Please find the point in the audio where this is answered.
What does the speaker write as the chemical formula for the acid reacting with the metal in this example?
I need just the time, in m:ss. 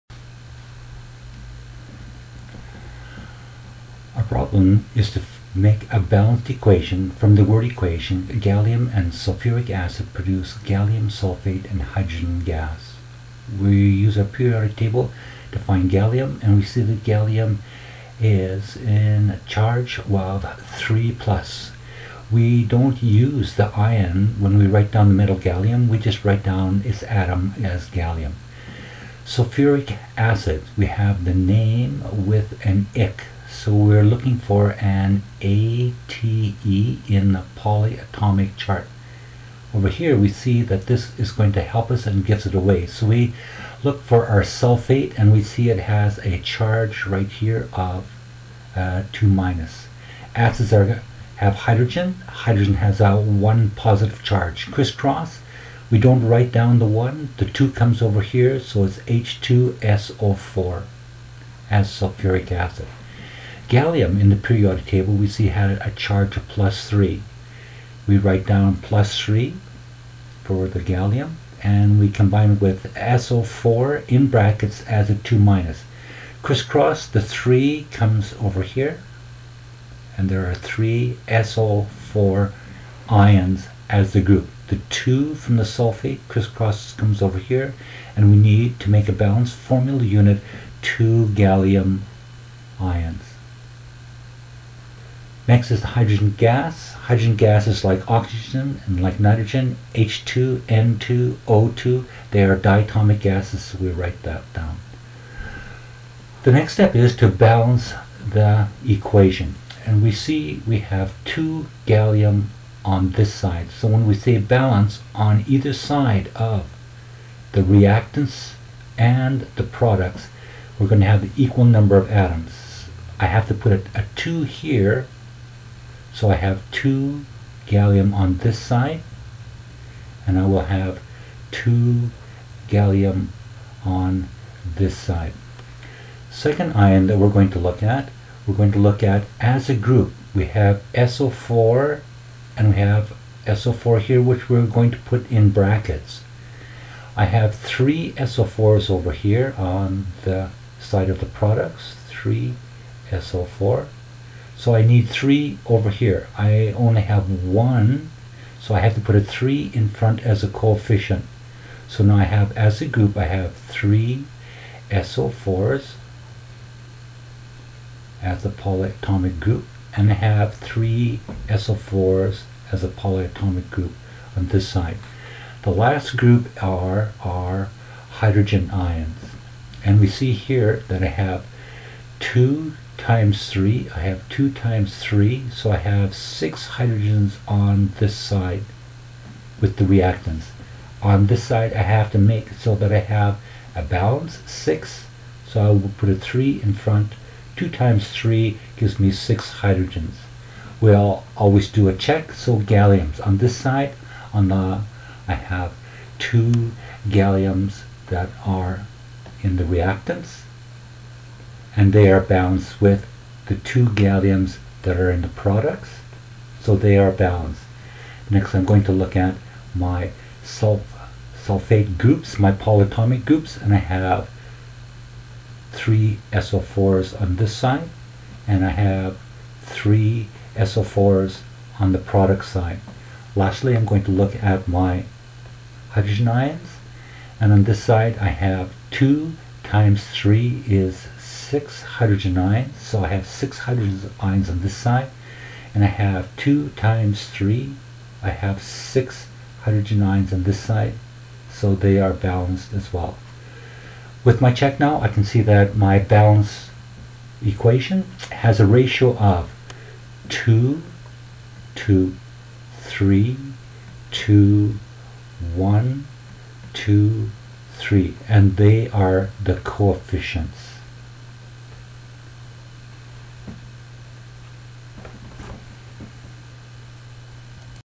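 0:58.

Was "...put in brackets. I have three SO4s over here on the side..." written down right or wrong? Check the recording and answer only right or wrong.
right.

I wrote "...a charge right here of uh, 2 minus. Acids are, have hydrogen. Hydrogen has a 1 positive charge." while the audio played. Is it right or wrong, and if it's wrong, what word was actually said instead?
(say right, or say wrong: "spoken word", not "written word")
right.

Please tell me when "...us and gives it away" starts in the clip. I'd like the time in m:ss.
0:41.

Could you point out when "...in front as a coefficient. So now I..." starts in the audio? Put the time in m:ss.
2:39.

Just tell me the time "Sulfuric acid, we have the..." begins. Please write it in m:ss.
0:29.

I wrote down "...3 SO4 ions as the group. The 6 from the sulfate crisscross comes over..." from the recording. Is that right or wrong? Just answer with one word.
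wrong.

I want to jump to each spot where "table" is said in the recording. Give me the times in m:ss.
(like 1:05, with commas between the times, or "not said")
0:14, 1:04.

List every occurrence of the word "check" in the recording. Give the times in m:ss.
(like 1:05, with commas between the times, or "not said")
3:21, 4:14.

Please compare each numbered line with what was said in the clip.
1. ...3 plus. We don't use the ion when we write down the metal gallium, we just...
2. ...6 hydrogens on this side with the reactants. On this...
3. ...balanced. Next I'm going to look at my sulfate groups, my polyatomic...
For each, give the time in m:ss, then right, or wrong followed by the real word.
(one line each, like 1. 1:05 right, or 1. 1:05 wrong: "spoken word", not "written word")
1. 0:20 right
2. 3:06 right
3. 3:37 right.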